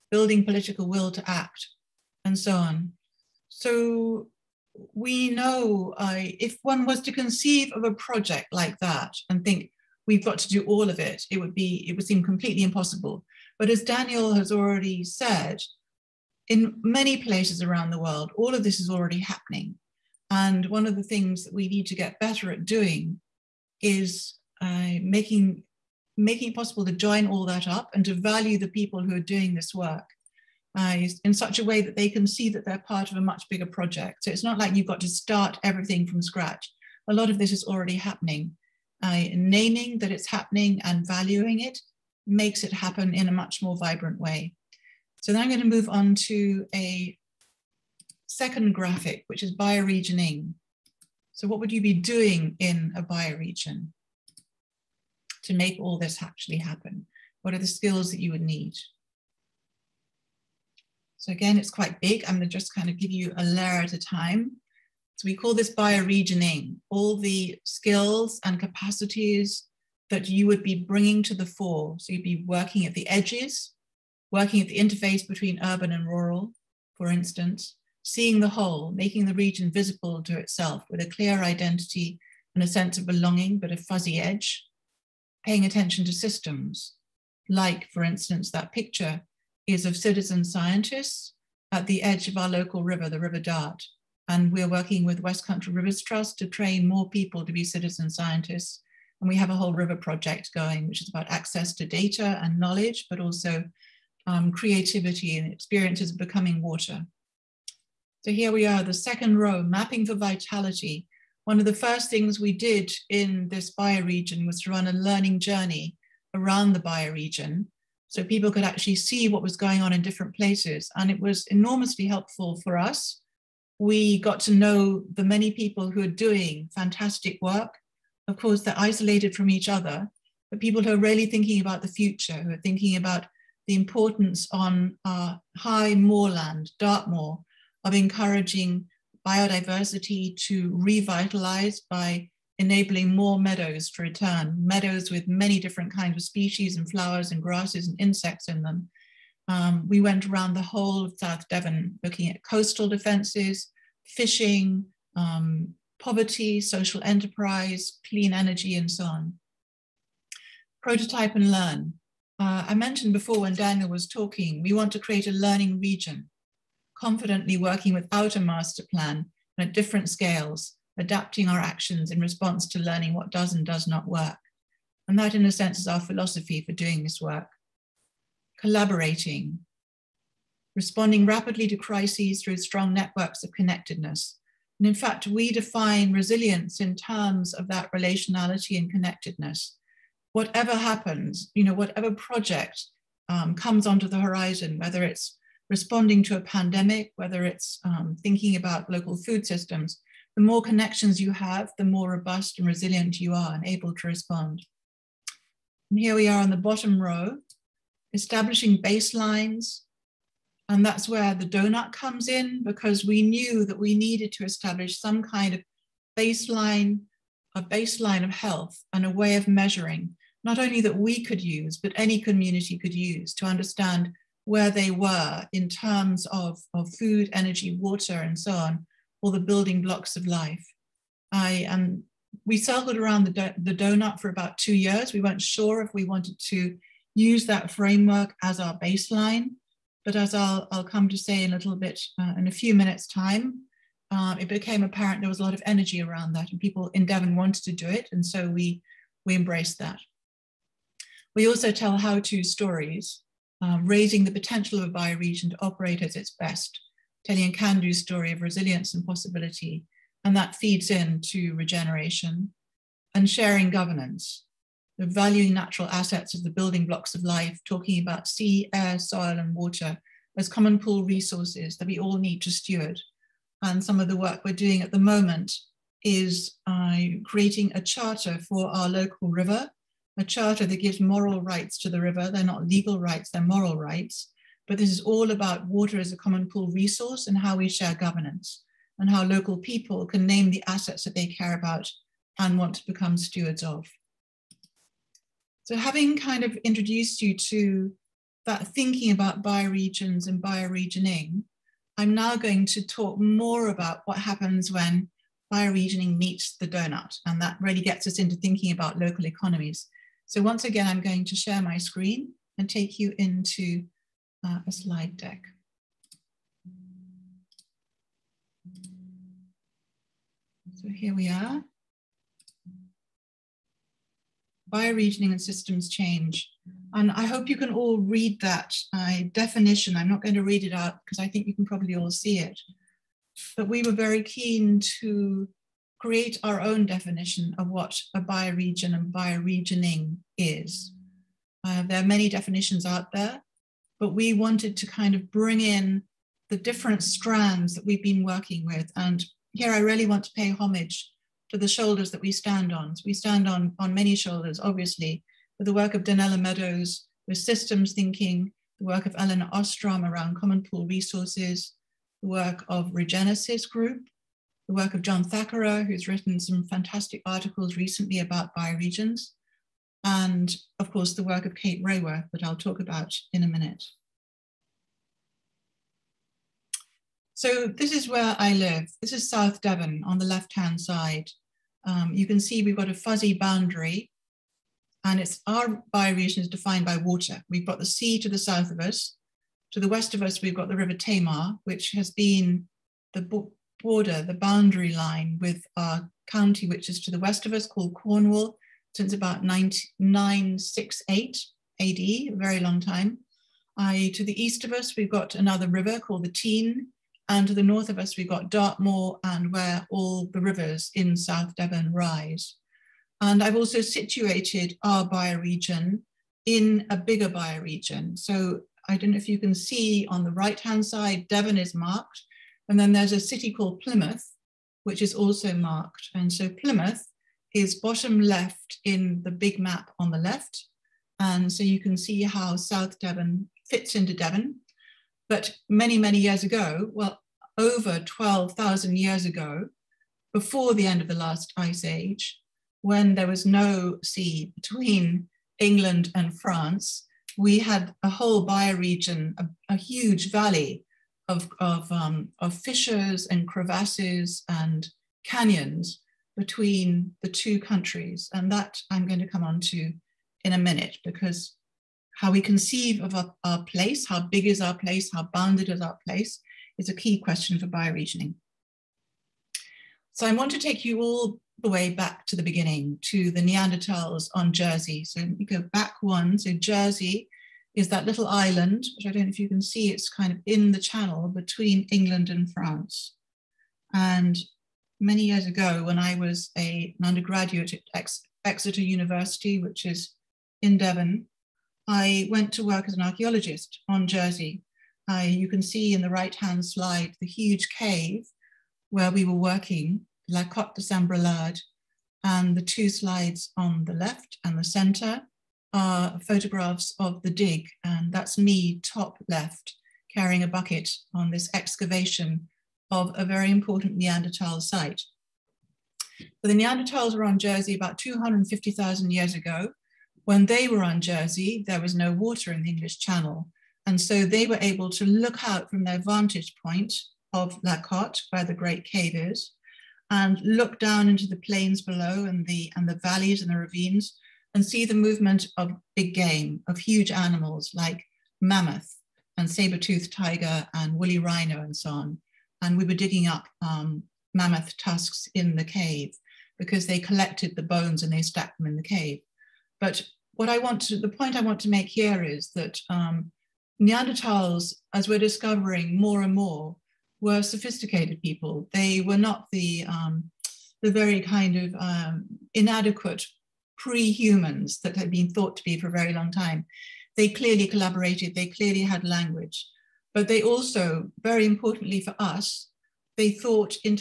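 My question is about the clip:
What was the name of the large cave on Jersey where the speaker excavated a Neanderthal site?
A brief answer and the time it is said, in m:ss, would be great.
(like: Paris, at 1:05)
La Cotte de Saint Brelade, at 8:20.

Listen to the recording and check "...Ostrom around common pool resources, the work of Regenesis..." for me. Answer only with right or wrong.
right.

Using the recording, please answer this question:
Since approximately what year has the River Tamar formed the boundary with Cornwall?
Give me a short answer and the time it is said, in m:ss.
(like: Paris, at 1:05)
968 AD, at 6:39.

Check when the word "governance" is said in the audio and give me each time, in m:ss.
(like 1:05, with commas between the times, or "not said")
4:23, 4:47.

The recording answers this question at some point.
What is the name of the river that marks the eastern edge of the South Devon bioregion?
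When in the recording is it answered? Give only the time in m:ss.
6:46.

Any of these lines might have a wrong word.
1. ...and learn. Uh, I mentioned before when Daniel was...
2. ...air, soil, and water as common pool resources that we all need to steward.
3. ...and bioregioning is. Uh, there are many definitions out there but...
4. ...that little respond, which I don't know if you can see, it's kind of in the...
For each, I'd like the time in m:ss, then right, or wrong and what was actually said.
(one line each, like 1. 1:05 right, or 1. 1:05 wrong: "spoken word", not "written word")
1. 2:41 right
2. 4:28 right
3. 5:38 right
4. 7:57 wrong: "island", not "respond".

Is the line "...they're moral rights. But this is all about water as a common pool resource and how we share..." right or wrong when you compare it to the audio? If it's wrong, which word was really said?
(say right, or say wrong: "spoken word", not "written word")
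right.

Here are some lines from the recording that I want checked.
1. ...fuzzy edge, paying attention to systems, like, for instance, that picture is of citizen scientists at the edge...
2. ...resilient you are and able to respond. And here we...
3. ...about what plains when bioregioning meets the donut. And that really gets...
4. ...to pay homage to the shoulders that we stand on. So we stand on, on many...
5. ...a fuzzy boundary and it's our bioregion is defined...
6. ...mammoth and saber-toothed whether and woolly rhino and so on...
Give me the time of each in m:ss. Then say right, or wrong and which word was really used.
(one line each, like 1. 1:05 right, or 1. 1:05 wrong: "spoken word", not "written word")
1. 1:23 right
2. 3:22 right
3. 5:03 wrong: "happens", not "plains"
4. 5:50 right
5. 6:22 right
6. 8:58 wrong: "tiger", not "whether".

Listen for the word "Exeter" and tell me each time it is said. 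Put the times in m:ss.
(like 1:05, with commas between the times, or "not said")
8:08.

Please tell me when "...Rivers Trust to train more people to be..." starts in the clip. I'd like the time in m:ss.
1:35.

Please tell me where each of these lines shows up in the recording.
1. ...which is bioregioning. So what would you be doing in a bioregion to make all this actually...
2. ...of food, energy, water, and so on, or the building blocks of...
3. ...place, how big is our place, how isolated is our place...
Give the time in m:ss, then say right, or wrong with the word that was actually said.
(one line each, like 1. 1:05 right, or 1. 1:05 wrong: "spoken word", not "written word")
1. 0:49 right
2. 3:46 right
3. 7:43 wrong: "bounded", not "isolated".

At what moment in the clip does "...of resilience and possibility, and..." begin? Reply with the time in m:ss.
4:18.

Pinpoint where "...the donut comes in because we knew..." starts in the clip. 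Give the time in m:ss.
3:31.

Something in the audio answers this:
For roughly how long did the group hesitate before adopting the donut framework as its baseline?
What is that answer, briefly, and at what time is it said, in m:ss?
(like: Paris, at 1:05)
about 2 years, at 3:54.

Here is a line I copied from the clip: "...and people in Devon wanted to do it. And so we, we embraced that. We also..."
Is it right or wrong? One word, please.
right.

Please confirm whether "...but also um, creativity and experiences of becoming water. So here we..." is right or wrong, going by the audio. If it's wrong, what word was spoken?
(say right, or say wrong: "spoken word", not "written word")
right.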